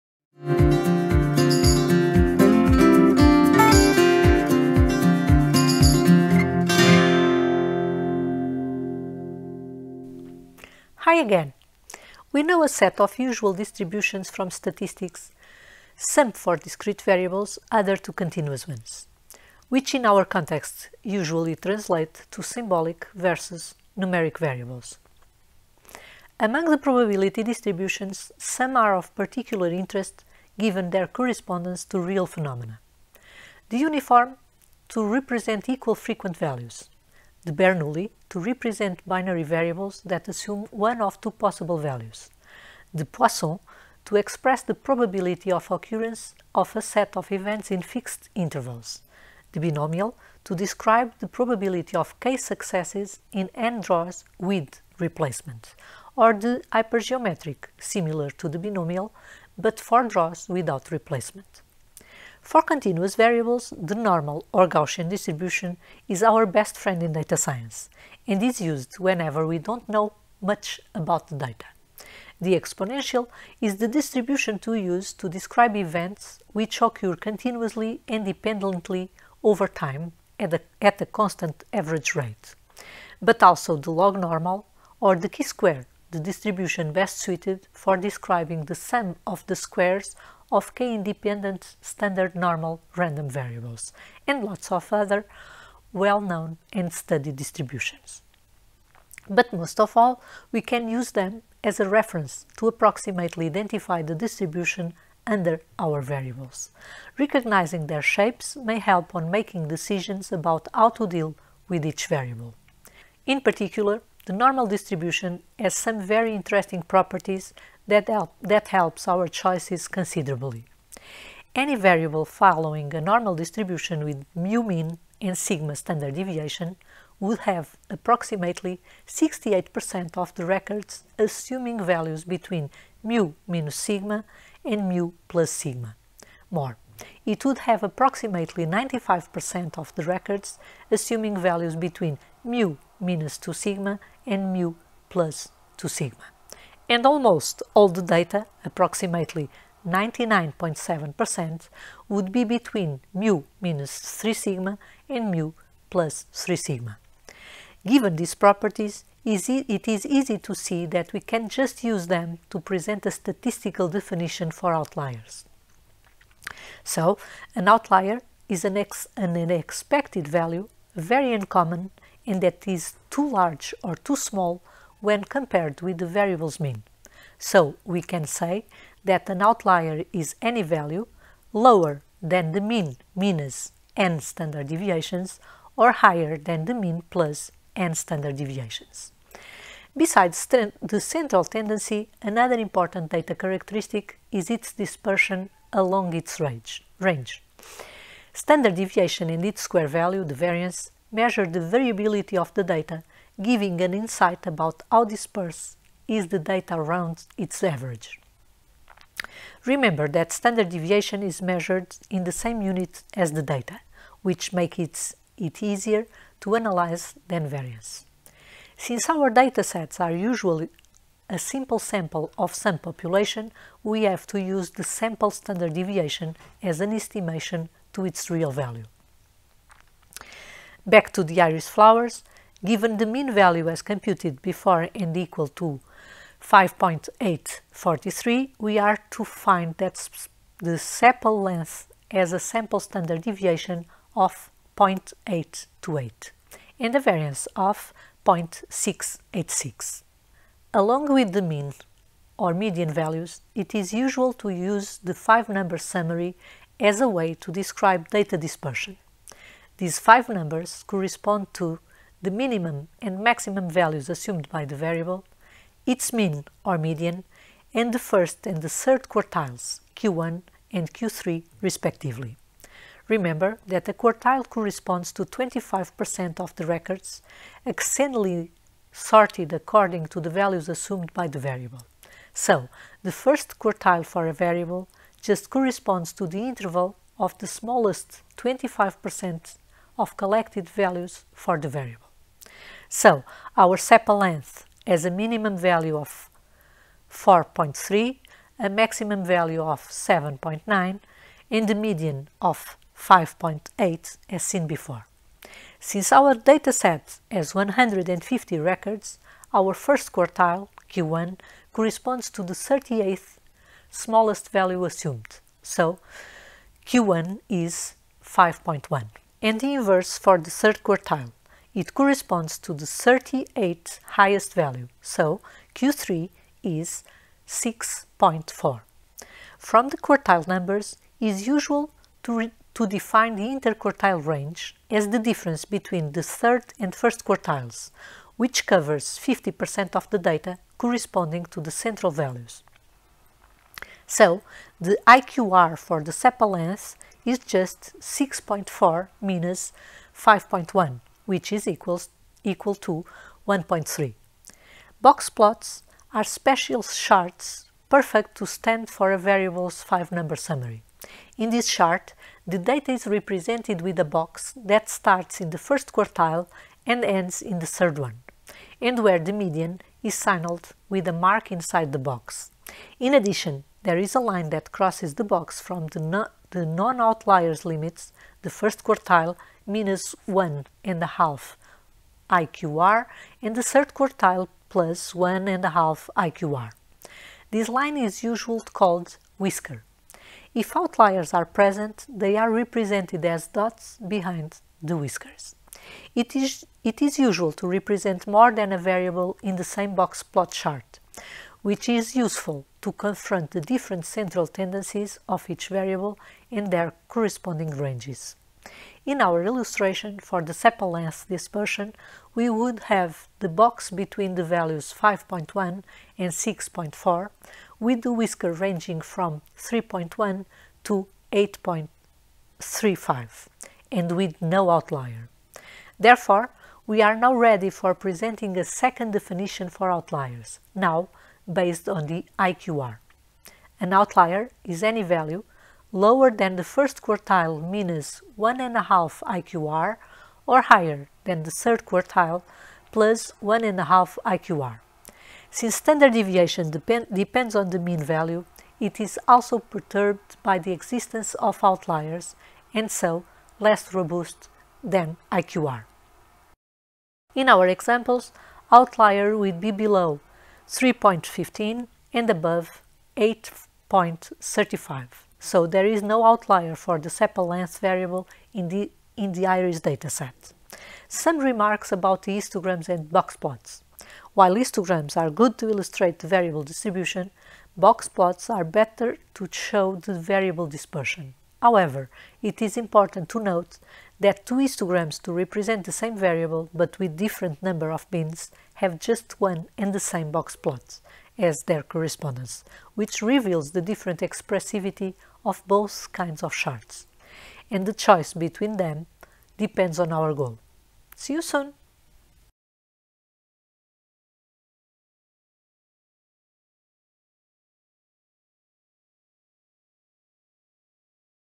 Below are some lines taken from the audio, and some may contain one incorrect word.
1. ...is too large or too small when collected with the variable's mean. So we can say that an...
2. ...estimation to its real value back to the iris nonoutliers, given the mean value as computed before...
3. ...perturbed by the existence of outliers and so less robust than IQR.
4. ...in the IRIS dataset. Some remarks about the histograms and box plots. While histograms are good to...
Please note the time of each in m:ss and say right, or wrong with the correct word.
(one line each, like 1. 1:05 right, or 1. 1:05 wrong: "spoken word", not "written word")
1. 2:52 wrong: "compared", not "collected"
2. 3:46 wrong: "flowers", not "nonoutliers"
3. 7:29 right
4. 7:49 right.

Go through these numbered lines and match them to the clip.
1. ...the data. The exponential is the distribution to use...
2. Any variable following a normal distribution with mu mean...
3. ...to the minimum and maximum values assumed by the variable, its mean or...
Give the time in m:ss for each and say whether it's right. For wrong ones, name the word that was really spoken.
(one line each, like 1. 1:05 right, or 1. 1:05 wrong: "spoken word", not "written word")
1. 1:11 right
2. 2:01 right
3. 4:21 right.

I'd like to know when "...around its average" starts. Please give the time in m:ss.
3:26.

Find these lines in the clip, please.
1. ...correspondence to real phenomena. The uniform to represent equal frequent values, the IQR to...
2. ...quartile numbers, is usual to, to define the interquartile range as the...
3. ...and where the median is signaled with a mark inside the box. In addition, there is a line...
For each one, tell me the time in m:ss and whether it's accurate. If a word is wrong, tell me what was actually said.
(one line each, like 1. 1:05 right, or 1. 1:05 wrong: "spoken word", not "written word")
1. 0:31 wrong: "Bernoulli", not "IQR"
2. 5:29 right
3. 6:08 right.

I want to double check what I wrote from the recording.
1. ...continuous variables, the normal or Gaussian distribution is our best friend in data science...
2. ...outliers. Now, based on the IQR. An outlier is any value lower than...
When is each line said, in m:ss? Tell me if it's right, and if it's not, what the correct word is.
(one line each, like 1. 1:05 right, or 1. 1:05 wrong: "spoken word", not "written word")
1. 1:02 right
2. 7:09 right.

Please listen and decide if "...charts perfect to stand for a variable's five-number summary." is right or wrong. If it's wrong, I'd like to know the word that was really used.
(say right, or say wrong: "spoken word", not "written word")
right.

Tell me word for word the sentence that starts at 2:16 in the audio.
More, it would have approximately 95% of the records assuming values between mu minus 2 sigma and mu plus 2 sigma.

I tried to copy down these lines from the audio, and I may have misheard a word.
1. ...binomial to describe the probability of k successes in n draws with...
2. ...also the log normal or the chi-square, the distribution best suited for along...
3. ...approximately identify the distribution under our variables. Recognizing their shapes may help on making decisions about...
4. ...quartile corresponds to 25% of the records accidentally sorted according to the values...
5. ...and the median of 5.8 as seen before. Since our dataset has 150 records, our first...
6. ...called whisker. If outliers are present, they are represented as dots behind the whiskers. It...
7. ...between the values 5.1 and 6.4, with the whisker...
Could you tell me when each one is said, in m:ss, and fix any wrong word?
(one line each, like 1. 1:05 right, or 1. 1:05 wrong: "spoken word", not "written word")
1. 0:49 right
2. 1:23 wrong: "describing", not "along"
3. 1:42 right
4. 4:33 right
5. 5:01 right
6. 6:28 right
7. 6:53 right.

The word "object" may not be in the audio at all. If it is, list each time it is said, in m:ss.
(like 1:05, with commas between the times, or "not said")
not said.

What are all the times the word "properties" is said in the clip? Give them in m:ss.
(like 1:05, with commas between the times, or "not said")
1:56, 2:38.